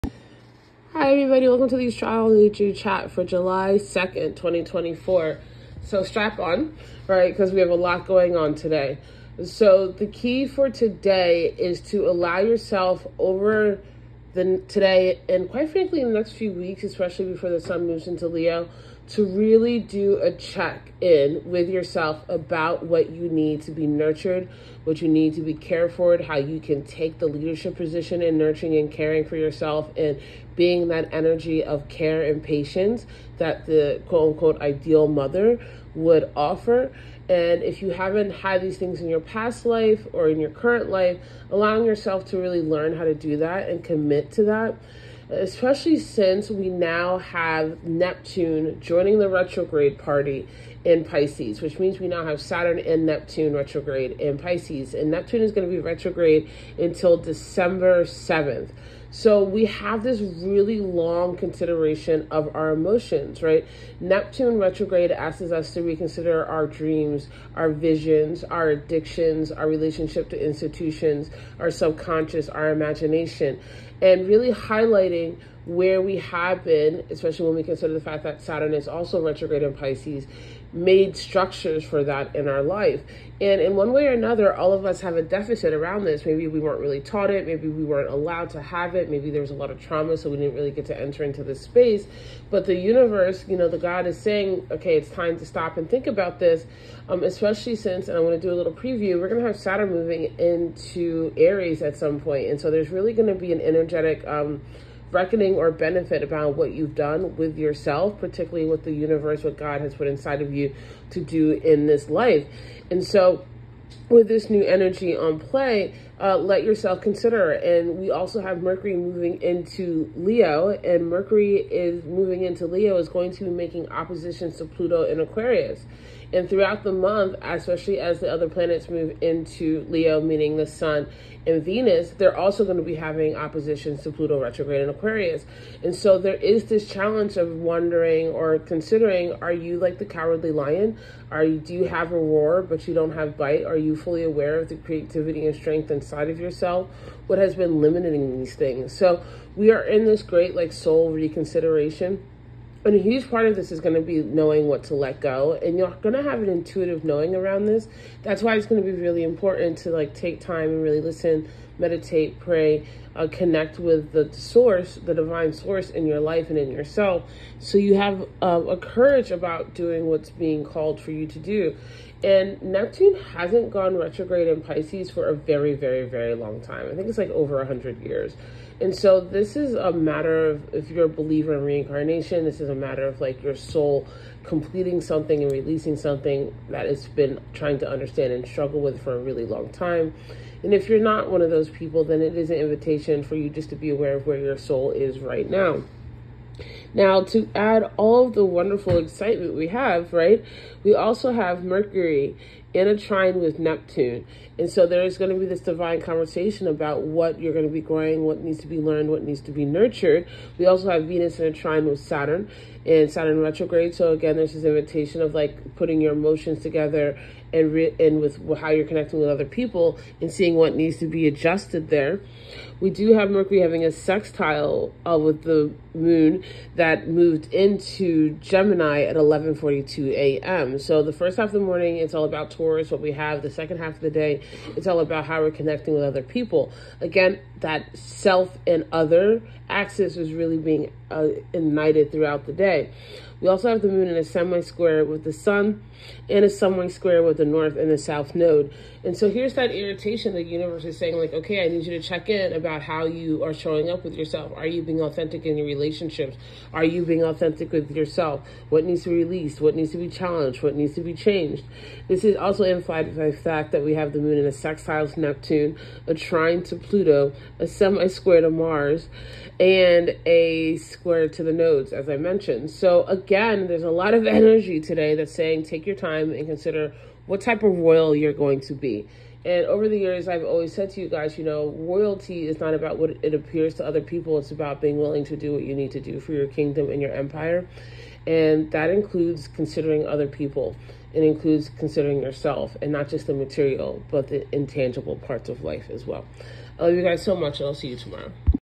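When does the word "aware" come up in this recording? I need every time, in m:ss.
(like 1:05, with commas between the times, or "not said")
2:24, 3:13.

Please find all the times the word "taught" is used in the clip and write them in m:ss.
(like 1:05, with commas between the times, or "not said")
1:27.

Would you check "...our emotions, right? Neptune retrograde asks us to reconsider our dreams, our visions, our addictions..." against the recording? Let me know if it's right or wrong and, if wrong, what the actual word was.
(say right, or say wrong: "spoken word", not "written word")
right.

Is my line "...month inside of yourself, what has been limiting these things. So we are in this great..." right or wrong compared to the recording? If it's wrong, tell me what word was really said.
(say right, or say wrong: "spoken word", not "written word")
wrong: "strength", not "month".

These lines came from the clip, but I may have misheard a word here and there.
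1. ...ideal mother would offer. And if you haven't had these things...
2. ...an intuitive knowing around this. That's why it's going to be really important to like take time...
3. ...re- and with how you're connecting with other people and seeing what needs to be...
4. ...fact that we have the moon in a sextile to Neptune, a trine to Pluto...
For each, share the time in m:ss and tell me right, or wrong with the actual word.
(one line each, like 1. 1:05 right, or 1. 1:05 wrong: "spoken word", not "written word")
1. 0:34 right
2. 2:36 right
3. 3:37 right
4. 4:23 right.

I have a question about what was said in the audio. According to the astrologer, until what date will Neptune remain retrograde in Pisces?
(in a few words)
December 7.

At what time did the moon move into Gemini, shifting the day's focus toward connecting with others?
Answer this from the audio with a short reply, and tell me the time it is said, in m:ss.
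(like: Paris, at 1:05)
11:42 a.m., at 3:49.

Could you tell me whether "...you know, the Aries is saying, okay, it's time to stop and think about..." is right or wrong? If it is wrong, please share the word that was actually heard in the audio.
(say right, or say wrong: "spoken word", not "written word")
wrong: "God", not "Aries".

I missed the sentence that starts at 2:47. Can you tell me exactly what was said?
So you have uh, a courage about doing what's being called for you to do.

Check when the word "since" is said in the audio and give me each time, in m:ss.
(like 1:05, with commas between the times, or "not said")
0:45, 1:37.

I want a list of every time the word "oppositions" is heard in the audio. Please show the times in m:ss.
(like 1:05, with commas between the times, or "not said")
2:03, 2:13.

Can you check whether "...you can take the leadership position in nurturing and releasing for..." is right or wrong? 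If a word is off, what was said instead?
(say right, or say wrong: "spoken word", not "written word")
wrong: "caring", not "releasing".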